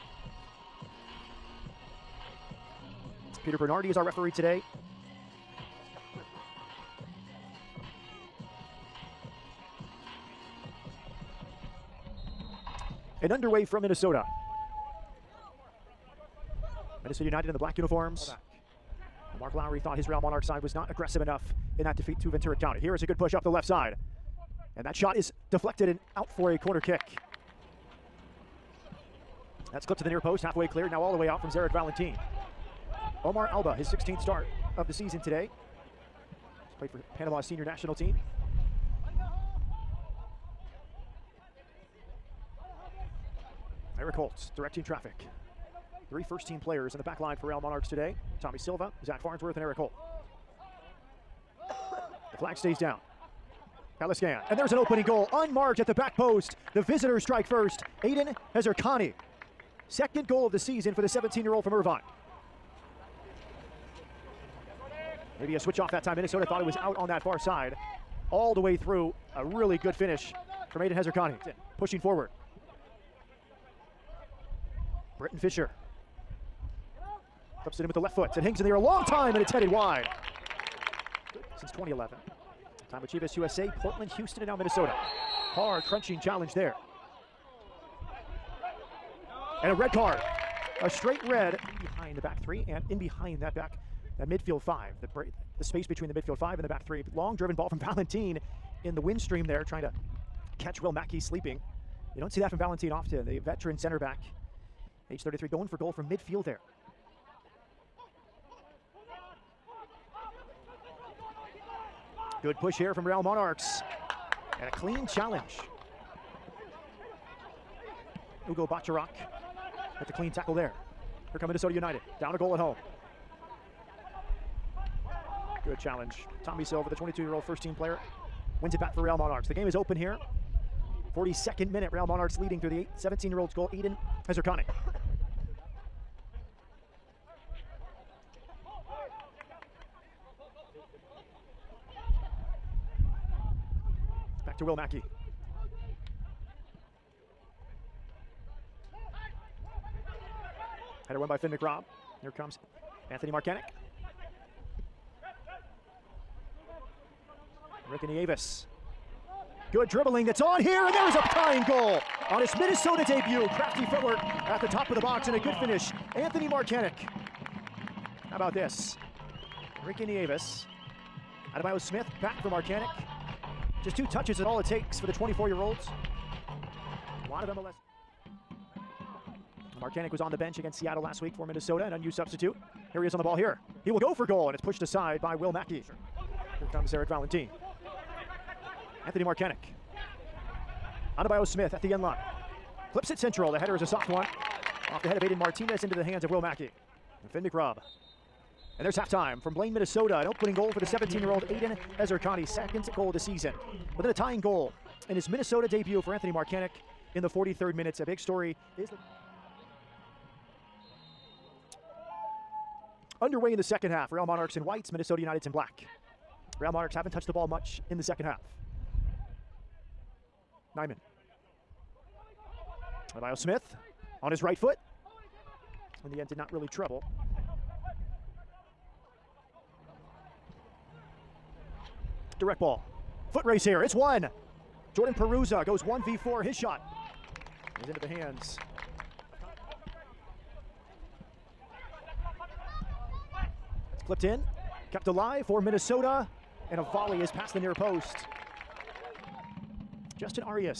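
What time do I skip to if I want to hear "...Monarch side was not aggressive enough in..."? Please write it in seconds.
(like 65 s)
20 s.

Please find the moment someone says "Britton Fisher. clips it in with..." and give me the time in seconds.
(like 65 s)
75 s.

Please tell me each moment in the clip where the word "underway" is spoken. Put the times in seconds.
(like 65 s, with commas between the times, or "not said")
13 s, 213 s.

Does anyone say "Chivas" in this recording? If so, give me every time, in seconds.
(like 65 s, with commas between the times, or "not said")
83 s.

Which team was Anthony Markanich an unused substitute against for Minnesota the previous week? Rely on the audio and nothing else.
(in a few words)
Seattle.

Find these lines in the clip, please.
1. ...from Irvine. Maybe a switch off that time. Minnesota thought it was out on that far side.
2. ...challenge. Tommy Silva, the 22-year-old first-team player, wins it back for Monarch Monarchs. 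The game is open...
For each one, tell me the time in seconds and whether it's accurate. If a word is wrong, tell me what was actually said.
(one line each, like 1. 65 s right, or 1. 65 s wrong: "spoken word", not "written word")
1. 61 s right
2. 125 s wrong: "Real", not "Monarch".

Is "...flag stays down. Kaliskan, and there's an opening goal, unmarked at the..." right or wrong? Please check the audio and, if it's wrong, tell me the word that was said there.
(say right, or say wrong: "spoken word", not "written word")
right.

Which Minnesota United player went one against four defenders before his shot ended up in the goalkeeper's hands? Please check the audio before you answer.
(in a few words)
Jordan Perruzza.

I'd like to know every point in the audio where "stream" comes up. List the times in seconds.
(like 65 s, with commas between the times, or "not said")
99 s.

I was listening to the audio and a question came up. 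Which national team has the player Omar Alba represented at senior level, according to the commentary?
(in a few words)
Panama.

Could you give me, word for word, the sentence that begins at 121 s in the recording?
Here come Minnesota United, down a goal at home.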